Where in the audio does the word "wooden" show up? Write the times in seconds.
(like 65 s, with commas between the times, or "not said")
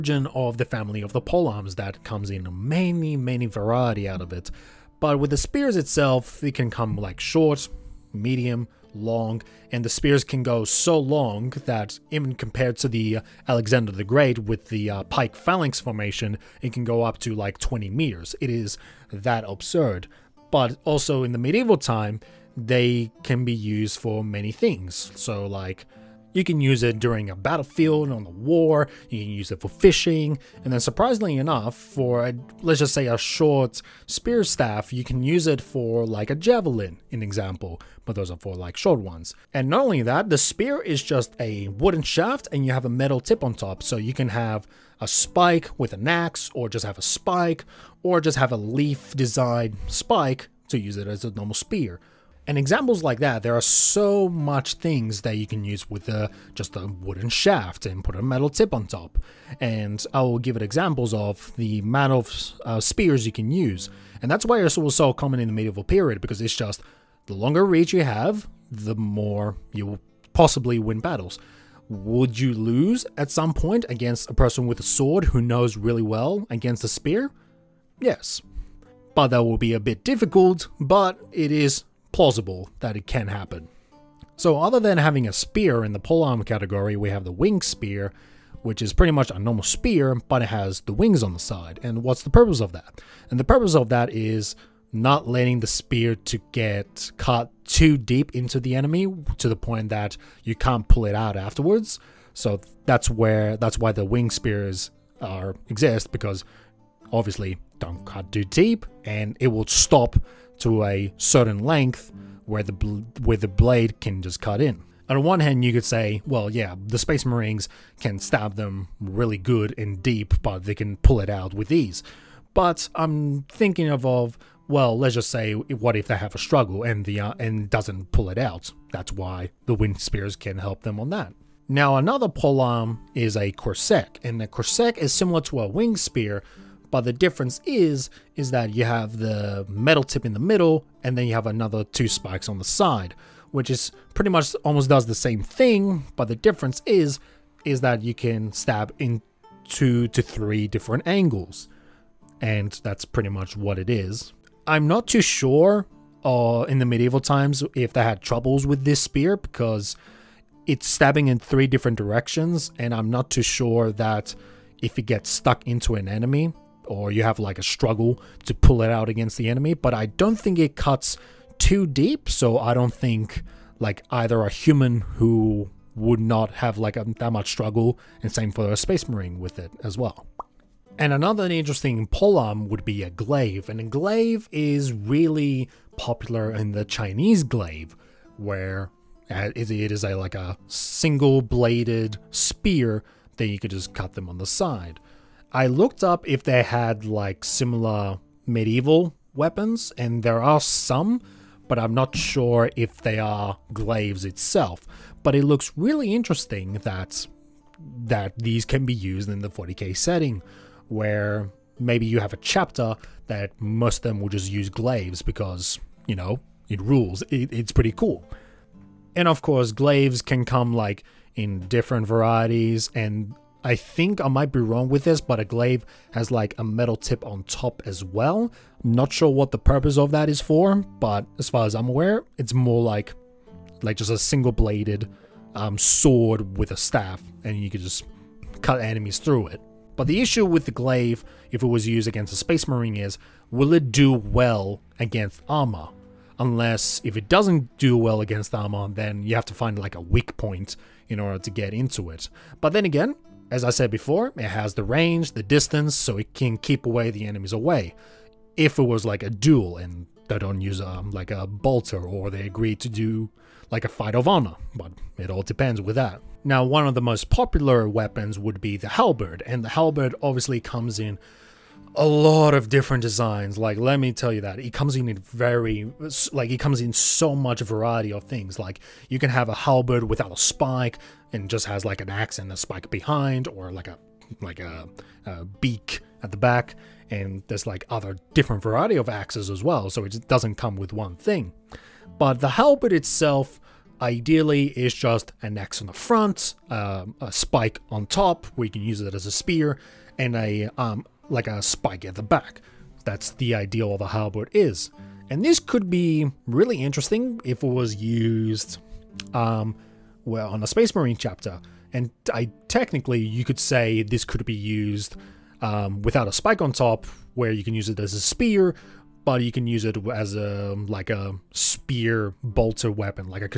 41 s, 56 s.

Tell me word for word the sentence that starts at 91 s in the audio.
And what's the purpose of that?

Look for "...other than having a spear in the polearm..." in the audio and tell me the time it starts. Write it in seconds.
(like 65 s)
84 s.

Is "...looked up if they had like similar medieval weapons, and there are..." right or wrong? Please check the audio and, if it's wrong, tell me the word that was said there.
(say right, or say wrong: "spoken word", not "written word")
right.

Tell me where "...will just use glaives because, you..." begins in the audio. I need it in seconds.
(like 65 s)
214 s.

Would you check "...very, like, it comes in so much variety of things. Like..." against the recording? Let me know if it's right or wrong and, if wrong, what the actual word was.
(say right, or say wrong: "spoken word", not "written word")
right.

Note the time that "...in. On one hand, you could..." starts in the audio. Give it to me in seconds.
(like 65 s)
114 s.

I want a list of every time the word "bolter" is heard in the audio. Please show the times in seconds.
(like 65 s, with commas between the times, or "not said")
261 s, 322 s.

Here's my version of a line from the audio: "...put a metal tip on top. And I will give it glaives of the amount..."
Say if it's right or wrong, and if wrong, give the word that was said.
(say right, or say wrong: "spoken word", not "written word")
wrong: "examples", not "glaives".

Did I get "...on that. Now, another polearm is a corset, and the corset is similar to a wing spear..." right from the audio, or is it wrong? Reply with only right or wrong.
right.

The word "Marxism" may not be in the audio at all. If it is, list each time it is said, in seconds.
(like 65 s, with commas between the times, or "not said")
not said.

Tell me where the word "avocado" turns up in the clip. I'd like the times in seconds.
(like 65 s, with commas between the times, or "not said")
not said.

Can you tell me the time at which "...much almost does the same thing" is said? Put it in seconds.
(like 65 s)
144 s.